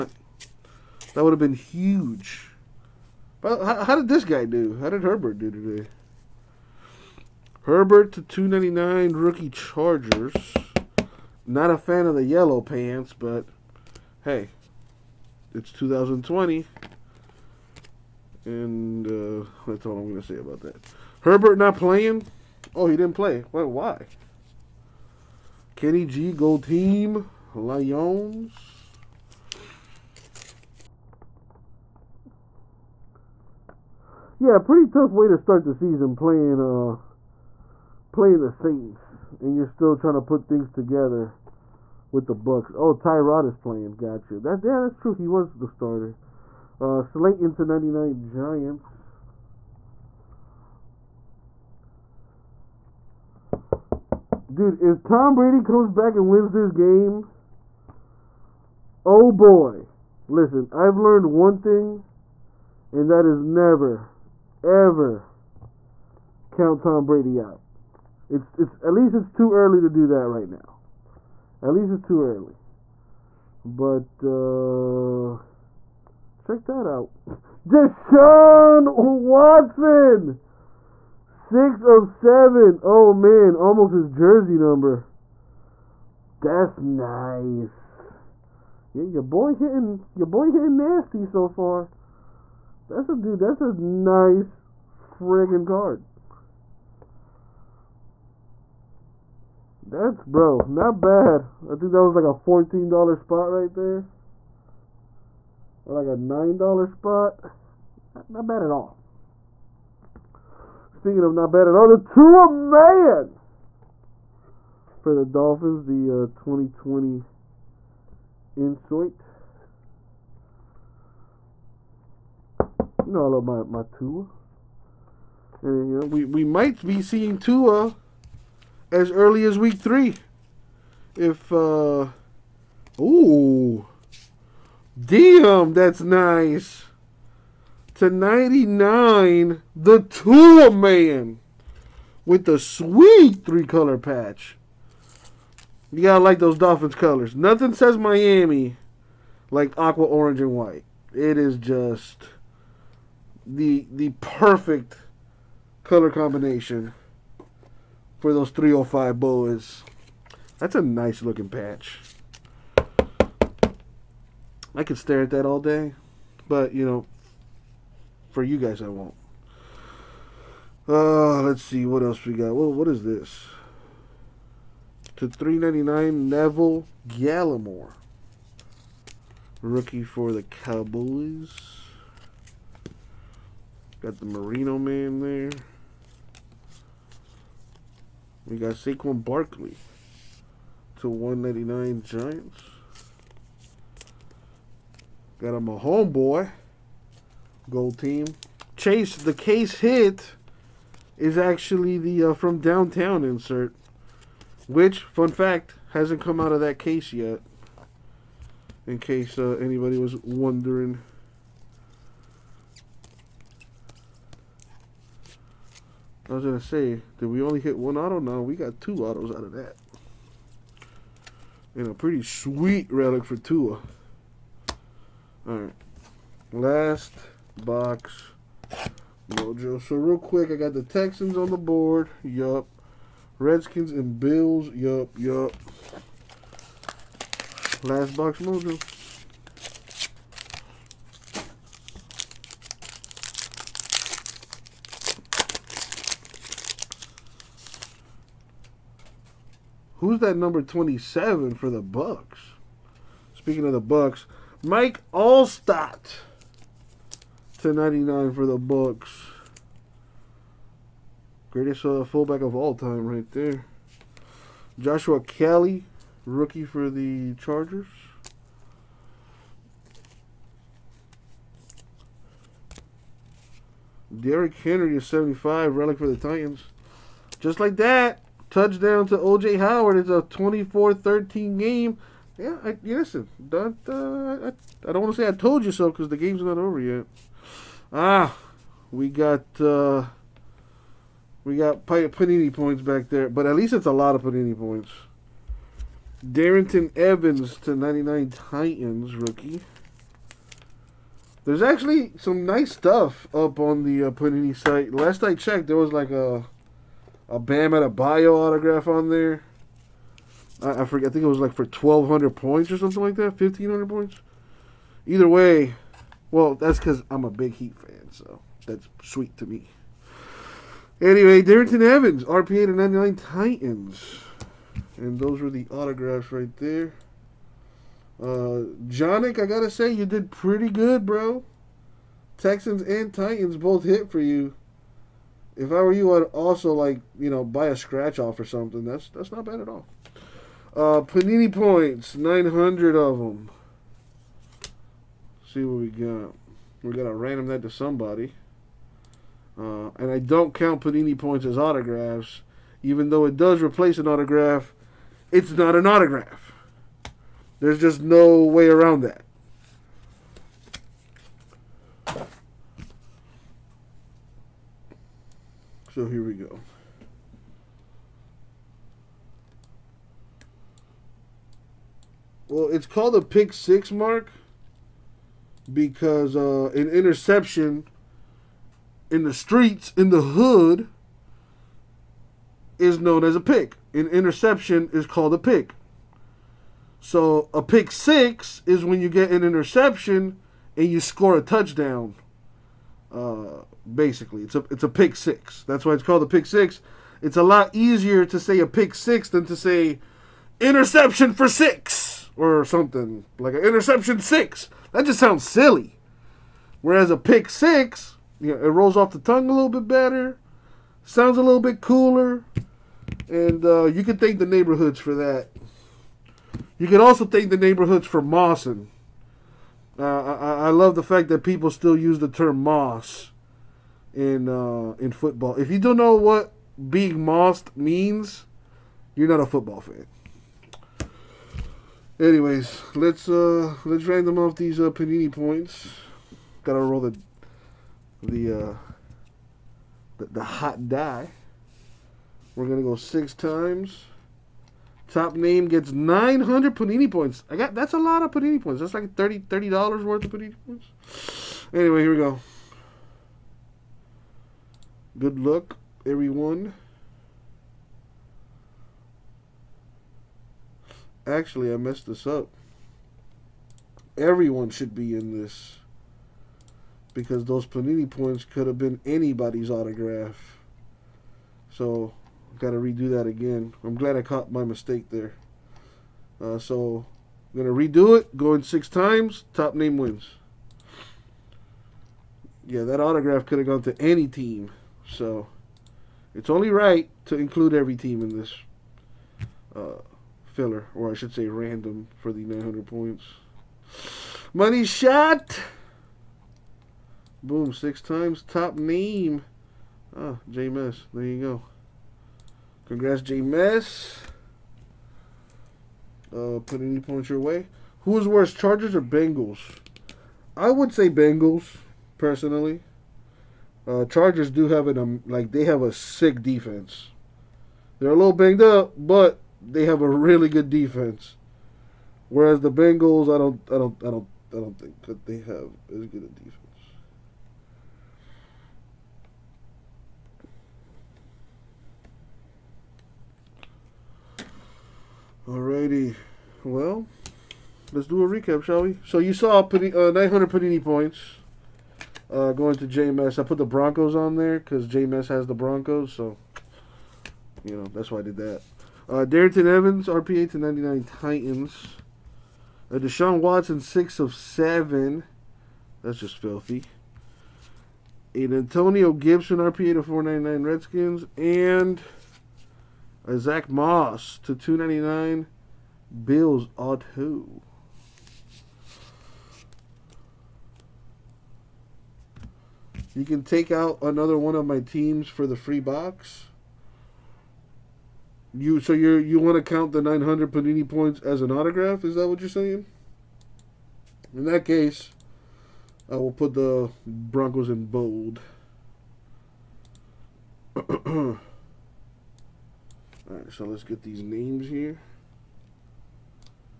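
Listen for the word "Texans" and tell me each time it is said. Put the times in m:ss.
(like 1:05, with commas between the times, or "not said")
3:50, 5:32.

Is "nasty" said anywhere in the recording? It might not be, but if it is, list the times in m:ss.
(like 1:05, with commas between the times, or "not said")
1:30.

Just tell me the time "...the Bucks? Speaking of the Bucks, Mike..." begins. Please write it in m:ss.
4:11.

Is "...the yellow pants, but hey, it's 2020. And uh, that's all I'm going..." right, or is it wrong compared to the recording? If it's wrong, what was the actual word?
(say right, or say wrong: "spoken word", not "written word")
right.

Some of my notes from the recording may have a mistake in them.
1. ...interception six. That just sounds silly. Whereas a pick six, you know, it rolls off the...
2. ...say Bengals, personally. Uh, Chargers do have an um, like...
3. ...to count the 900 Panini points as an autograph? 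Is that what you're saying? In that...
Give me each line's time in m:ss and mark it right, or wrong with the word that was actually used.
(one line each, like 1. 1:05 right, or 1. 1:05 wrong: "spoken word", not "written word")
1. 6:43 right
2. 8:30 right
3. 9:39 right.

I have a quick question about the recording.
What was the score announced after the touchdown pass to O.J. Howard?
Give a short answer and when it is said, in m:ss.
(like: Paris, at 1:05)
24-13, at 4:40.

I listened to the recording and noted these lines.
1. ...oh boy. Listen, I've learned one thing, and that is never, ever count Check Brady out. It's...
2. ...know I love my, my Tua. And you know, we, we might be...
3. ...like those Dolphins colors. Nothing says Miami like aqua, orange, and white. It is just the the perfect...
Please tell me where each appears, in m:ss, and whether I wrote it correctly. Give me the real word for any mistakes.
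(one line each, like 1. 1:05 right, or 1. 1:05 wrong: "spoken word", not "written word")
1. 0:59 wrong: "Tom", not "Check"
2. 2:03 right
3. 2:26 right.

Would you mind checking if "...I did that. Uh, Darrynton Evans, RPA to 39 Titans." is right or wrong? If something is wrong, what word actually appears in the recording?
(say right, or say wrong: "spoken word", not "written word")
wrong: "99", not "39".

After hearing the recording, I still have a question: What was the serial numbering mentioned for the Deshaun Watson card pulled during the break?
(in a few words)
6 of 7.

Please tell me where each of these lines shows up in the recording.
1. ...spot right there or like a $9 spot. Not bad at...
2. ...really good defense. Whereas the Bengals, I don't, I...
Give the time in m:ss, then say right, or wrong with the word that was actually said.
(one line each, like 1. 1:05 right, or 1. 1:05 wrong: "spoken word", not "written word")
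1. 1:43 right
2. 8:40 right.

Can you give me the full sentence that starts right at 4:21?
Greatest uh, fullback of all time right there.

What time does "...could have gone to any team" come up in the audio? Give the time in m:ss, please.
8:03.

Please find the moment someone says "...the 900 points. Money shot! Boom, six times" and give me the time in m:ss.
8:12.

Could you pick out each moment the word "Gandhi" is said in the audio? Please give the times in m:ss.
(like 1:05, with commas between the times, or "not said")
not said.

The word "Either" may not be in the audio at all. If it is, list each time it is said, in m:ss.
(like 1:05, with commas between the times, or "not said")
5:15.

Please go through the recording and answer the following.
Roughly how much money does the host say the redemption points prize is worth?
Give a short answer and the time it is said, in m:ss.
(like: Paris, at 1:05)
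$30, at 7:29.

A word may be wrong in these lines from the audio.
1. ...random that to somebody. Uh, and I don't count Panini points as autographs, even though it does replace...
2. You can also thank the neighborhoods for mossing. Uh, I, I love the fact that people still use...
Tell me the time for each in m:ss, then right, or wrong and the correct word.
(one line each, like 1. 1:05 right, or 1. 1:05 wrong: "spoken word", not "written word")
1. 5:47 right
2. 6:56 right.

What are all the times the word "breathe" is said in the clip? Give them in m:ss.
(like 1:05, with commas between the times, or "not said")
not said.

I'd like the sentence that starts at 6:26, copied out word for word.
So a pick six is when you get an interception and you score a touchdown.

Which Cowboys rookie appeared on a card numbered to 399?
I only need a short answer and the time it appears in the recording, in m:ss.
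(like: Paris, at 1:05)
Neville Gallimore, at 2:56.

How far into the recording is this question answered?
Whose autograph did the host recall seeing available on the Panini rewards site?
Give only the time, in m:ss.
5:07.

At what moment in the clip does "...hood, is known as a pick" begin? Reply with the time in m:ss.
6:20.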